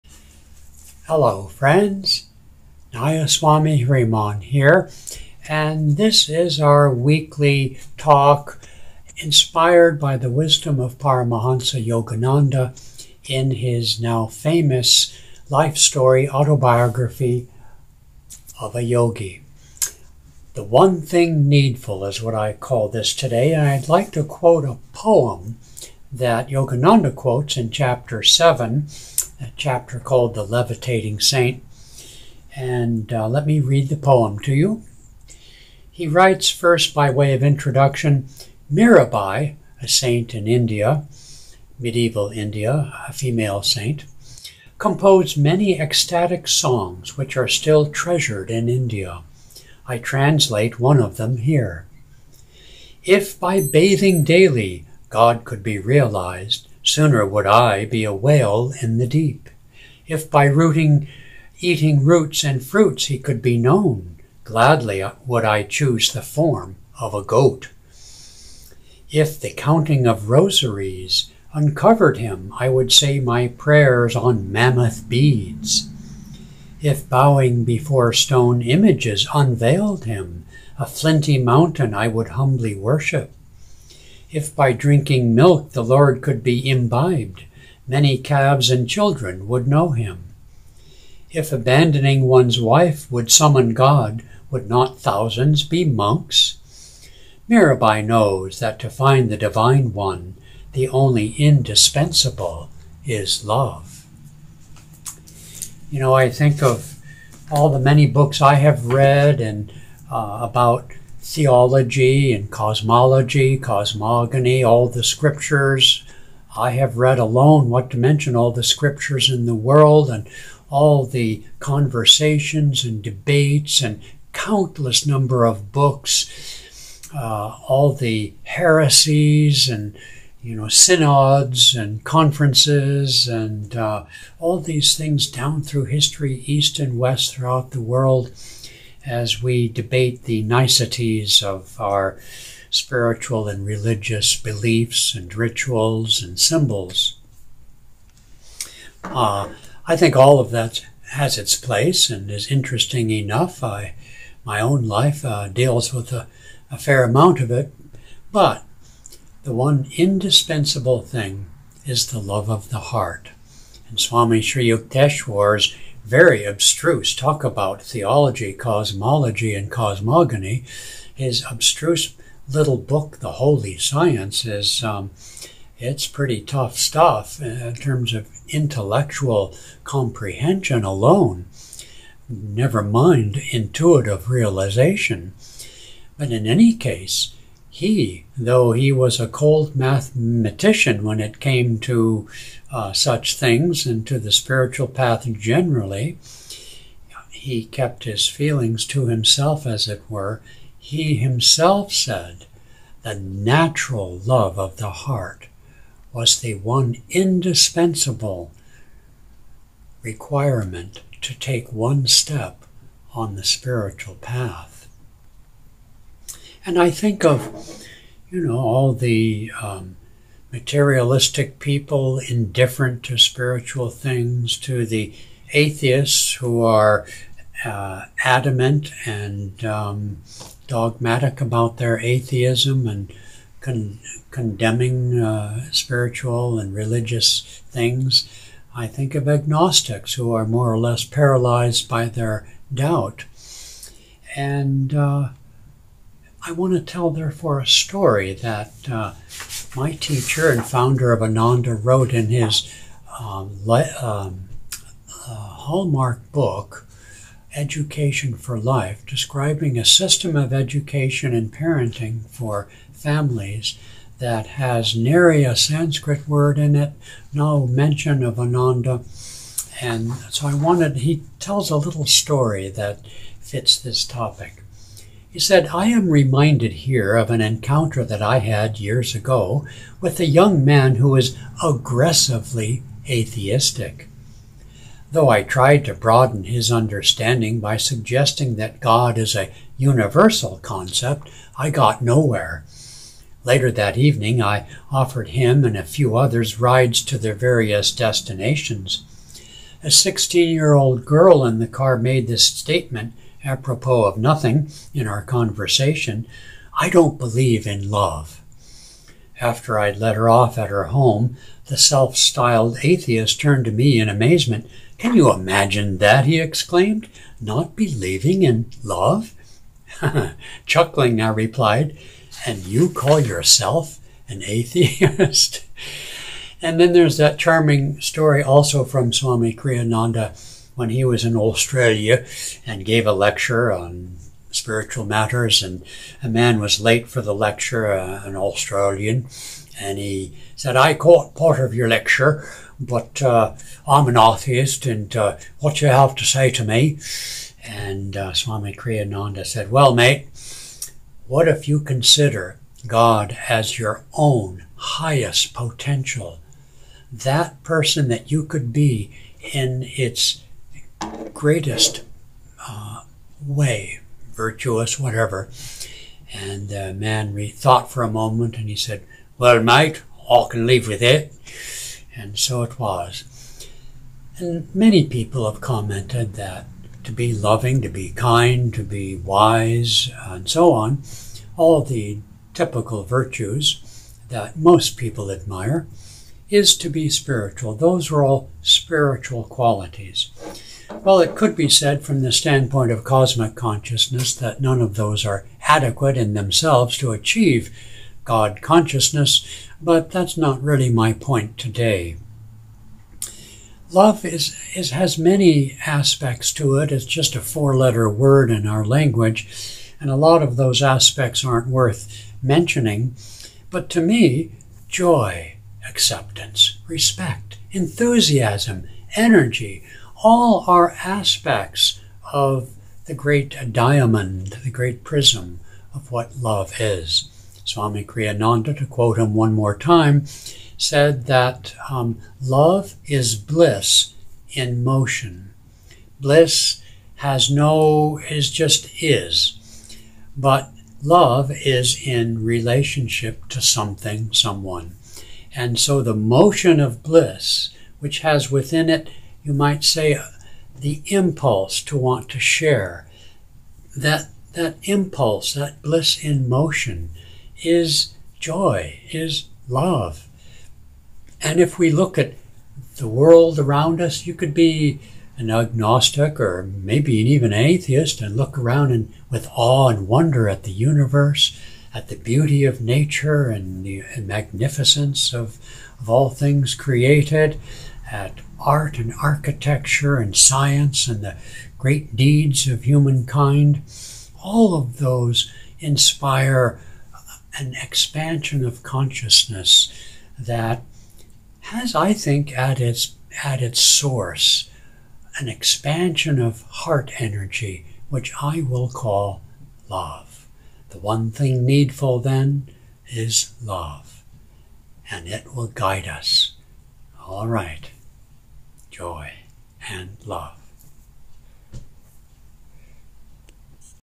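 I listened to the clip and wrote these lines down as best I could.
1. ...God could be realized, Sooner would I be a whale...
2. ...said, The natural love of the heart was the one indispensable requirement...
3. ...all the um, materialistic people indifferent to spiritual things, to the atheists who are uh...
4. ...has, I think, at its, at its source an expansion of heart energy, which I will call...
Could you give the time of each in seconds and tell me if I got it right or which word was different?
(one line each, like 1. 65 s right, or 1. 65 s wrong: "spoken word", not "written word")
1. 55 s right
2. 201 s right
3. 218 s right
4. 491 s right.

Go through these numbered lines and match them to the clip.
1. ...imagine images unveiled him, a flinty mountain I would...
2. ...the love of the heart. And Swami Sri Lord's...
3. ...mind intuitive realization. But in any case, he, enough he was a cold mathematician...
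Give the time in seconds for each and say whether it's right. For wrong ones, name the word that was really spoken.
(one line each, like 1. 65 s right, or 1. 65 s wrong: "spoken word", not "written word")
1. 78 s wrong: "stone", not "imagine"
2. 162 s wrong: "Yukteswar", not "Lord"
3. 182 s wrong: "though", not "enough".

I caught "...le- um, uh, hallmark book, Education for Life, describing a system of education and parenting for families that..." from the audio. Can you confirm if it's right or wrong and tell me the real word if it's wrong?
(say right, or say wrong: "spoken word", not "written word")
right.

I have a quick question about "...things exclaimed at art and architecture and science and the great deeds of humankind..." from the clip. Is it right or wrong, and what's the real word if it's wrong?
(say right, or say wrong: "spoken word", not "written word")
wrong: "created", not "exclaimed".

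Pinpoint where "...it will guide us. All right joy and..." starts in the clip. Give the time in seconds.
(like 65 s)
505 s.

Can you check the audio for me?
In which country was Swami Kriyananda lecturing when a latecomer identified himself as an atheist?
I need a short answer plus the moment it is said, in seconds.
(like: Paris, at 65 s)
Australia, at 331 s.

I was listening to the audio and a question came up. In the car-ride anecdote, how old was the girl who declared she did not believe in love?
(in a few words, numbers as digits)
16.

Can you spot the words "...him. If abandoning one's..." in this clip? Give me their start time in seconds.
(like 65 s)
89 s.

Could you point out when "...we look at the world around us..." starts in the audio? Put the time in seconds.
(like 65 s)
461 s.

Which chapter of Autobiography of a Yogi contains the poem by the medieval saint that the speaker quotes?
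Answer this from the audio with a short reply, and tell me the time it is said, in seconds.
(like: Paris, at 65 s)
Chapter 7, at 27 s.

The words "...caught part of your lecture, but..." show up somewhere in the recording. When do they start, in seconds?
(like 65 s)
340 s.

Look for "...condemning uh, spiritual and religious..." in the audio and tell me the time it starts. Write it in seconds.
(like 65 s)
234 s.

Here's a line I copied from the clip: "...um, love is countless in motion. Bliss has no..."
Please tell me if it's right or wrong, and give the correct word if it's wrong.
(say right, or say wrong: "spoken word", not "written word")
wrong: "bliss", not "countless".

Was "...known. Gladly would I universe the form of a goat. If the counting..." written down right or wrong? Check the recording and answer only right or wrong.
wrong.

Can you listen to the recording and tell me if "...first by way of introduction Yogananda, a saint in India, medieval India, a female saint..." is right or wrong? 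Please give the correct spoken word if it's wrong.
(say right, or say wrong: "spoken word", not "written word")
wrong: "Mirabai", not "Yogananda".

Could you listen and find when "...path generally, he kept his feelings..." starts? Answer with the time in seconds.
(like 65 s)
194 s.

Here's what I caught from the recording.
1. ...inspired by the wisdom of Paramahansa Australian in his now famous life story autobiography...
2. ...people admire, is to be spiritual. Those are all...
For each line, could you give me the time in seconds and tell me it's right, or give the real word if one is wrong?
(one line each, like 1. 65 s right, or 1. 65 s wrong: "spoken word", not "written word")
1. 9 s wrong: "Yogananda", not "Australian"
2. 384 s right.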